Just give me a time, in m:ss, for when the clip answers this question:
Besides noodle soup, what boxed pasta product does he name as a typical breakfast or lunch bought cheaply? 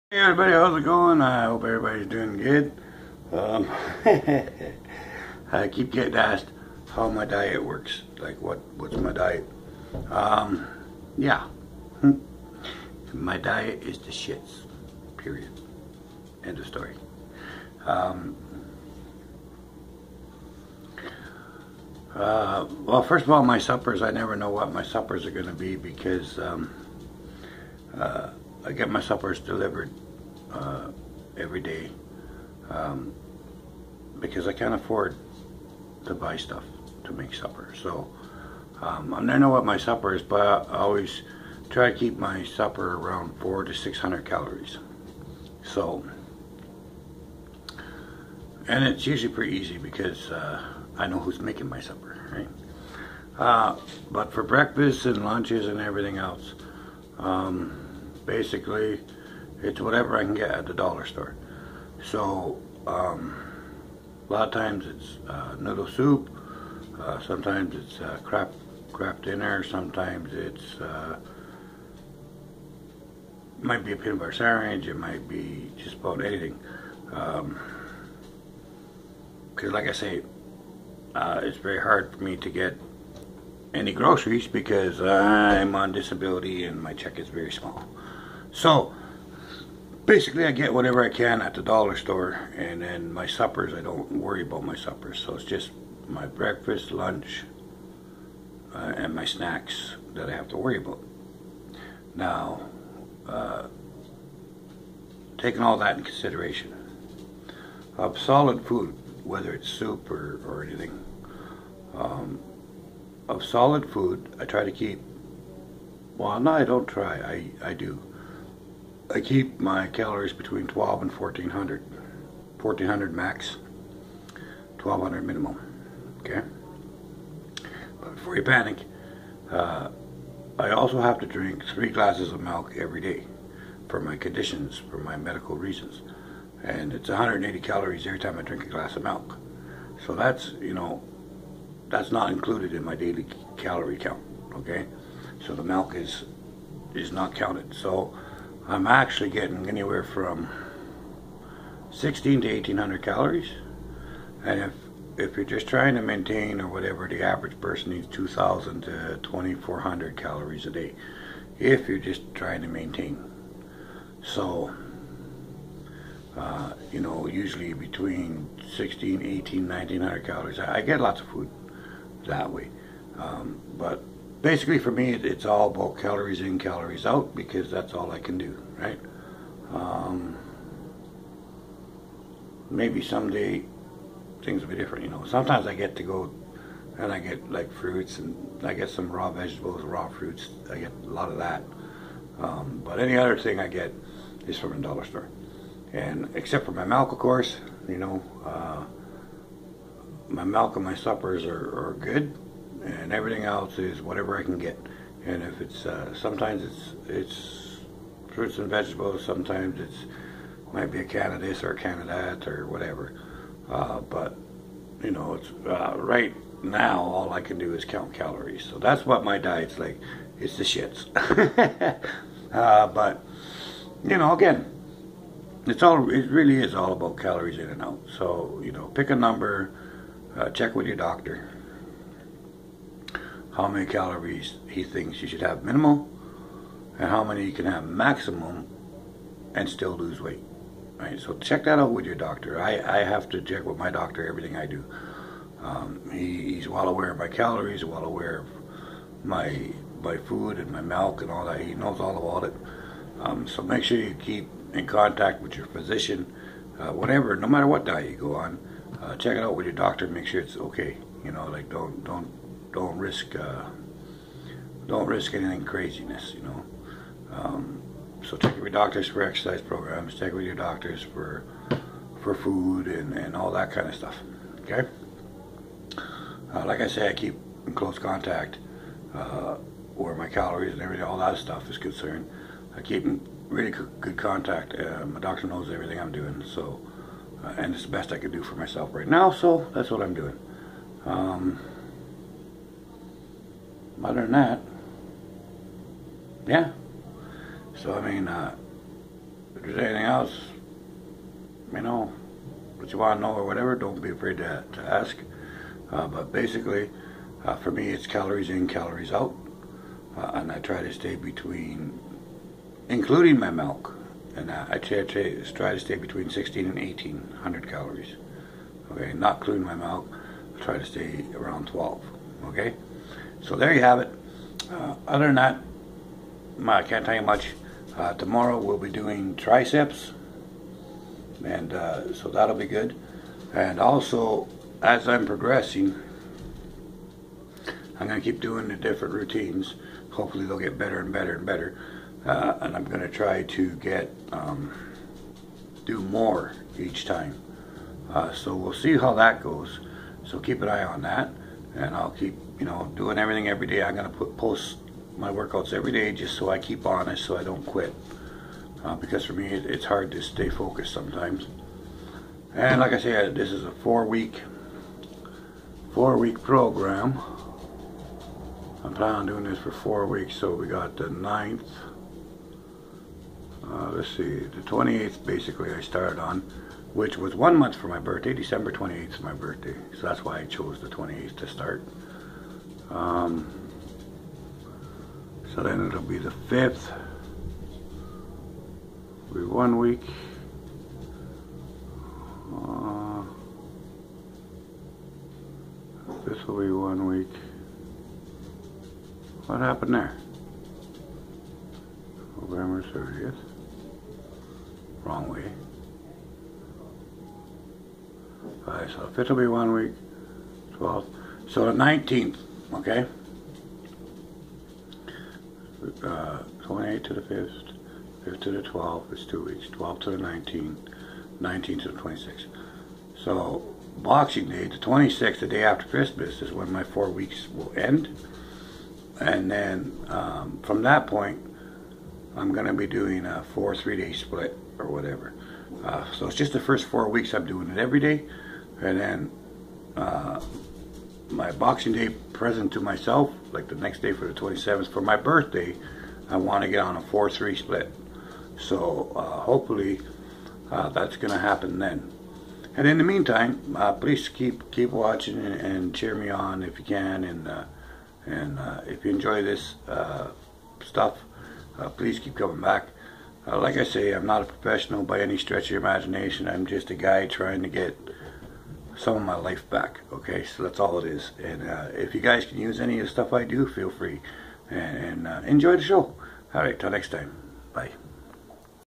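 1:08.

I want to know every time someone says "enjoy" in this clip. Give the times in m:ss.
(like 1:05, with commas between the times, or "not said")
7:39, 7:55.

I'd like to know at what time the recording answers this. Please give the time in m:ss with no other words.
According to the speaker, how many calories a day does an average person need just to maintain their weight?
2:38.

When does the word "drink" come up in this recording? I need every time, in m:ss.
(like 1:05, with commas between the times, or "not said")
2:11, 2:18.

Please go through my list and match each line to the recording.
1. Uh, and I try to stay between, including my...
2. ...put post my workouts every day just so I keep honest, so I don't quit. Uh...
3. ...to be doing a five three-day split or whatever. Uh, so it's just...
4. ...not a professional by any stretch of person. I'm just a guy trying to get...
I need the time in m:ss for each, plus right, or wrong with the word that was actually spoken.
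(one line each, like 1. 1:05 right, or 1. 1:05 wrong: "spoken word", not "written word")
1. 5:10 right
2. 5:54 right
3. 7:12 wrong: "four", not "five"
4. 7:44 wrong: "imagination", not "person".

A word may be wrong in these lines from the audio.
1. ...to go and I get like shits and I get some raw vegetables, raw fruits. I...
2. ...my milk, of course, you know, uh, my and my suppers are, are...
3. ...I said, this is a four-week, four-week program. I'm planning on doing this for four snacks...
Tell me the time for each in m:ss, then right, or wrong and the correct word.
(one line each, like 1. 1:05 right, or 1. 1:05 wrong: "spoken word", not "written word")
1. 3:05 wrong: "fruits", not "shits"
2. 3:16 right
3. 6:02 wrong: "weeks", not "snacks".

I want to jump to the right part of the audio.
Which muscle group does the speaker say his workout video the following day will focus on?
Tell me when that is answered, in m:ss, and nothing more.
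5:29.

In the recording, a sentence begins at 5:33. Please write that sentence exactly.
And also, as I'm progressing, I'm going to keep doing the different routines.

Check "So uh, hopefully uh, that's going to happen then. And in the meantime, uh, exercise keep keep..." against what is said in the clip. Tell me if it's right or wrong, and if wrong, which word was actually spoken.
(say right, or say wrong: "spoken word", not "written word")
wrong: "please", not "exercise".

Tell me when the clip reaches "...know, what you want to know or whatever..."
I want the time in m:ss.
5:01.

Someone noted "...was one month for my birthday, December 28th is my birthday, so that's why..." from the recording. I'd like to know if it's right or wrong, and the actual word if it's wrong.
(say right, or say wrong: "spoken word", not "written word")
right.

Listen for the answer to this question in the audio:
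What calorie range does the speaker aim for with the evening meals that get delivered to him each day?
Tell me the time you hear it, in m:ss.
0:43.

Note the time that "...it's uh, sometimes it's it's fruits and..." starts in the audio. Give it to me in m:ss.
3:25.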